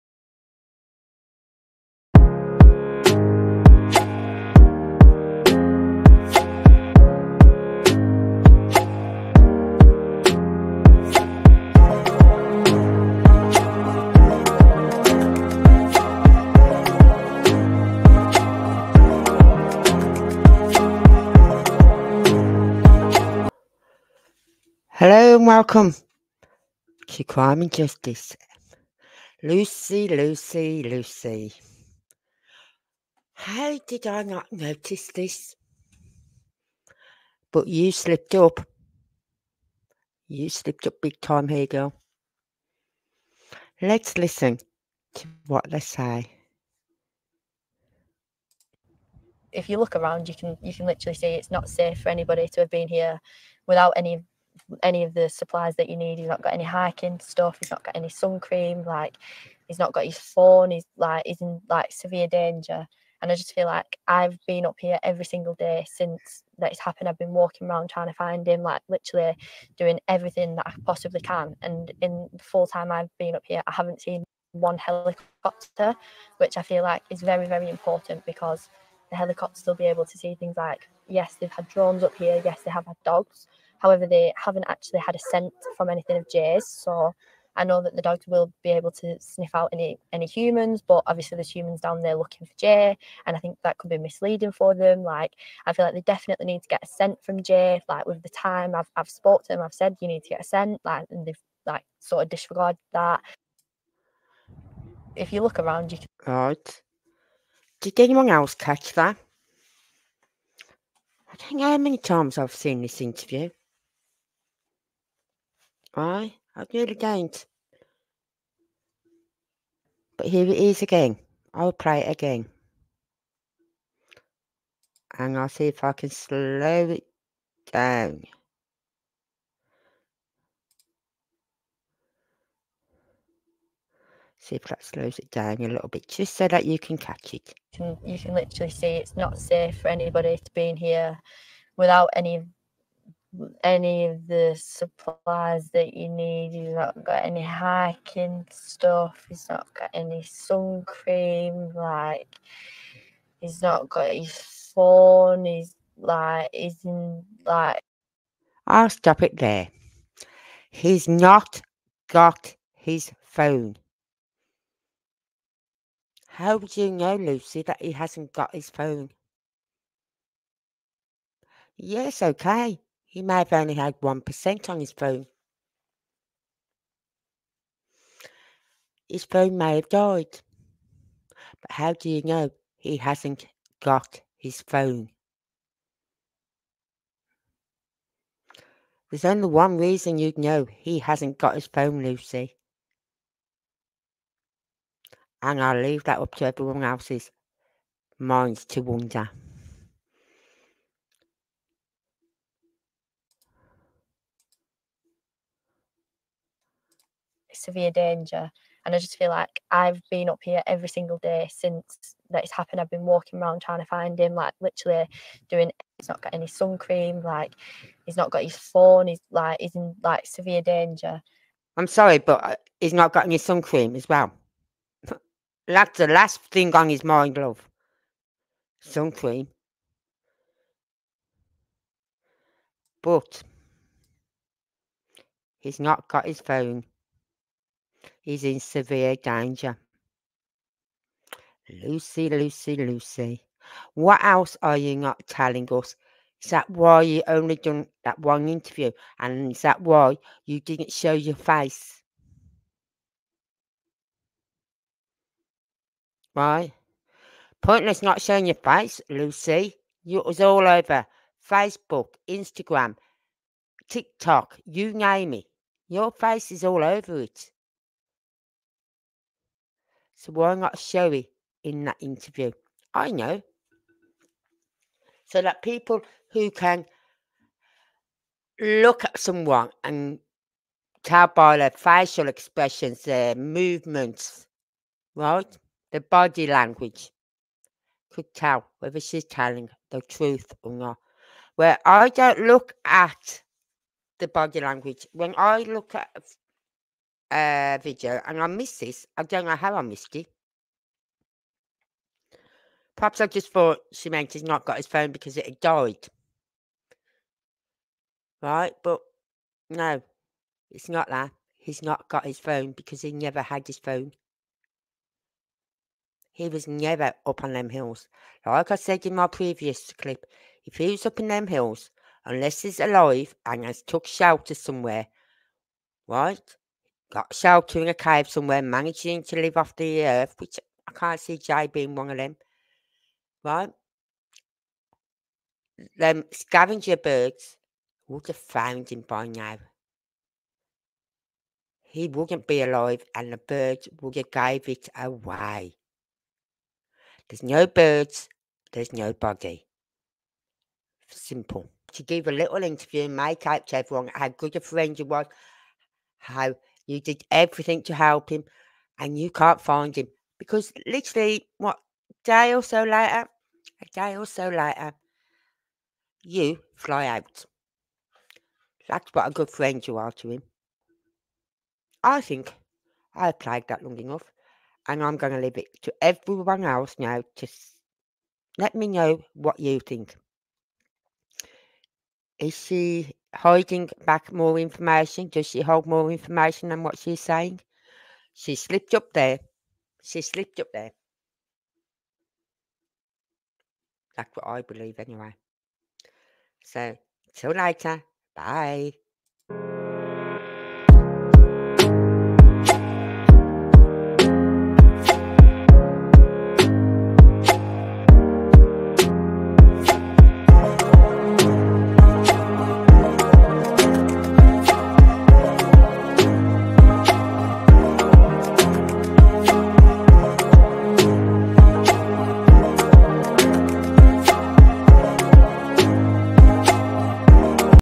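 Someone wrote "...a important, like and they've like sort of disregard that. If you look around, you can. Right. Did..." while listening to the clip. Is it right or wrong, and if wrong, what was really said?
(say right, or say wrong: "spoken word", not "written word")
wrong: "scent", not "important".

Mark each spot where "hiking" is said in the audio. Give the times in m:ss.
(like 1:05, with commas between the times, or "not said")
0:56, 2:27.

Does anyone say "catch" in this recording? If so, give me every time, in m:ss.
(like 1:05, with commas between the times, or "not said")
1:48, 2:16.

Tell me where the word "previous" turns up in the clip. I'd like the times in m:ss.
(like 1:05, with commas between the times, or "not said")
5:19.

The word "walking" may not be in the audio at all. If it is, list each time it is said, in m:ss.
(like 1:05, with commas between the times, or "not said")
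1:07, 3:33.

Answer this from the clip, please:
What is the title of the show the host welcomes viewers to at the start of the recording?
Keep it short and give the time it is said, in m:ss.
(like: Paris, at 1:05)
Crime and Justice, at 0:27.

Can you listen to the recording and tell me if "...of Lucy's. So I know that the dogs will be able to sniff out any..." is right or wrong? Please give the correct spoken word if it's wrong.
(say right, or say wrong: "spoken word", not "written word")
wrong: "Jay", not "Lucy".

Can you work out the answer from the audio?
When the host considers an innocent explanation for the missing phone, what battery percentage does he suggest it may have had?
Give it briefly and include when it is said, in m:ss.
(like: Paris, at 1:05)
1%, at 2:53.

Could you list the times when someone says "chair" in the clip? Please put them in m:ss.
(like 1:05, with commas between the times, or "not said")
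not said.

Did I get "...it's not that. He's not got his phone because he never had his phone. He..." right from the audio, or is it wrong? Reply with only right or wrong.
right.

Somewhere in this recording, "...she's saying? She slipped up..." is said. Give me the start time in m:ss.
6:26.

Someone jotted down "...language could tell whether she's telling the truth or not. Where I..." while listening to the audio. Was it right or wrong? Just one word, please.
right.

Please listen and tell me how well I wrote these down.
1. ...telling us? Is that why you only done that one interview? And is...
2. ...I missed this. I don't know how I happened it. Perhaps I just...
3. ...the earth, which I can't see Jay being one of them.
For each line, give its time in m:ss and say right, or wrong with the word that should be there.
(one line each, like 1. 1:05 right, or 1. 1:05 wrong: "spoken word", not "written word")
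1. 4:05 right
2. 4:58 wrong: "missed", not "happened"
3. 5:29 right.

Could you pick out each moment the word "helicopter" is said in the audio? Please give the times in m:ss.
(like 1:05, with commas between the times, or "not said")
1:14, 1:19.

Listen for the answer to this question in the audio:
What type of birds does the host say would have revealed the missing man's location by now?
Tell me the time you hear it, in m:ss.
5:36.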